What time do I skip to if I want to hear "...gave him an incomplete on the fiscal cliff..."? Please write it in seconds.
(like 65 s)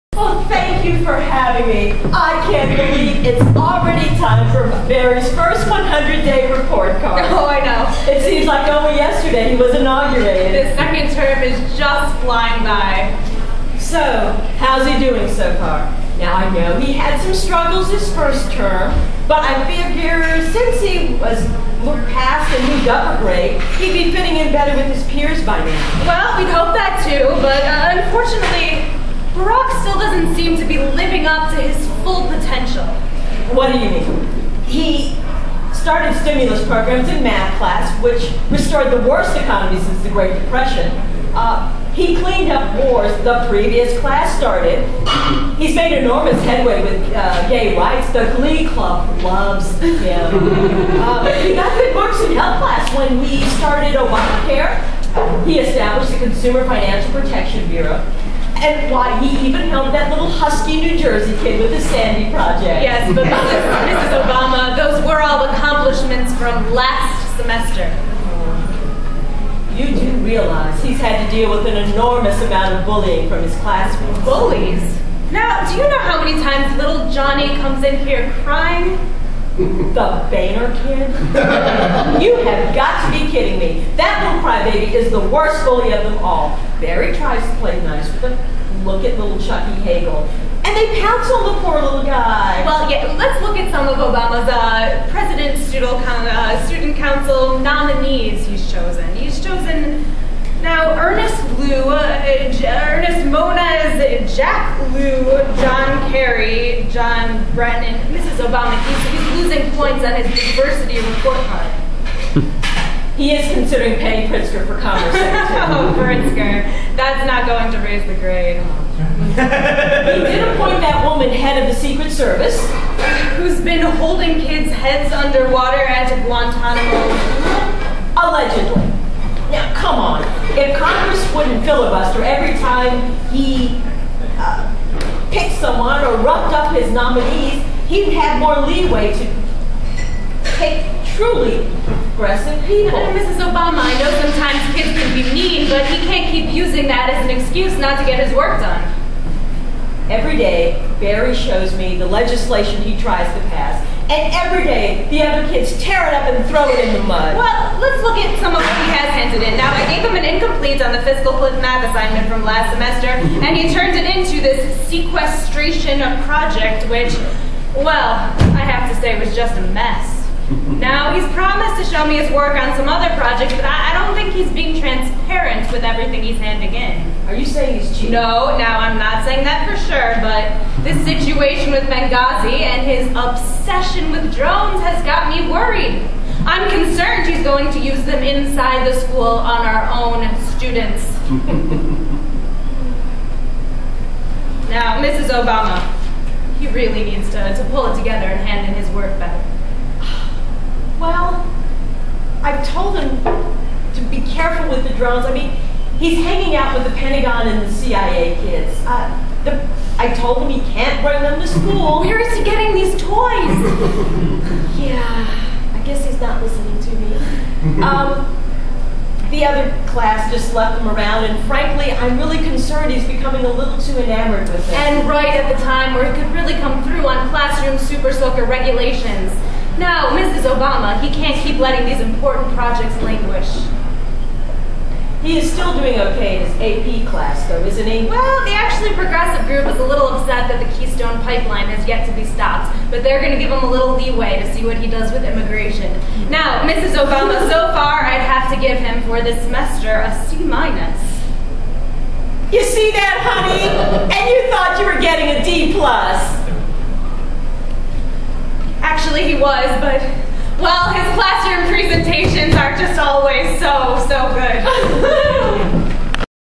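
159 s.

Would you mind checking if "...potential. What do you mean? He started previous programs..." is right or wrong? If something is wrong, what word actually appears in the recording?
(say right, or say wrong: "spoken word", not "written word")
wrong: "stimulus", not "previous".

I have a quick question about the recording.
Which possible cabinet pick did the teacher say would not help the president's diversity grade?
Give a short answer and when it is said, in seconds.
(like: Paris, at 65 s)
Penny Pritzker, at 113 s.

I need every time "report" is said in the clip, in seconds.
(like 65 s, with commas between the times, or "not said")
6 s, 110 s.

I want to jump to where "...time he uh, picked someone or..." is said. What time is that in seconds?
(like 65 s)
132 s.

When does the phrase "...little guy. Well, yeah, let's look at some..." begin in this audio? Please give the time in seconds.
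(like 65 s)
91 s.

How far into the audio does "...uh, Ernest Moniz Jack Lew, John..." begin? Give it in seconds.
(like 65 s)
101 s.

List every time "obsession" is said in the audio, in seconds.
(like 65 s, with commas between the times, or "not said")
183 s.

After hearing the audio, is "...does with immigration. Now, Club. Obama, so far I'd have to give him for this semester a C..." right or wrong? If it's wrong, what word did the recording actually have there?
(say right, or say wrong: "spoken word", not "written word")
wrong: "Mrs", not "Club".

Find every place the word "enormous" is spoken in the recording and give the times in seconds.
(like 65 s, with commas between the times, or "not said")
45 s, 71 s.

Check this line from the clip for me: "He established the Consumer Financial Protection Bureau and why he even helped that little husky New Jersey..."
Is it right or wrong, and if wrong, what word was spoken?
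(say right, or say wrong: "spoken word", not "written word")
right.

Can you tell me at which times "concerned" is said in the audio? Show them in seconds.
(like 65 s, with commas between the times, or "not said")
186 s, 222 s.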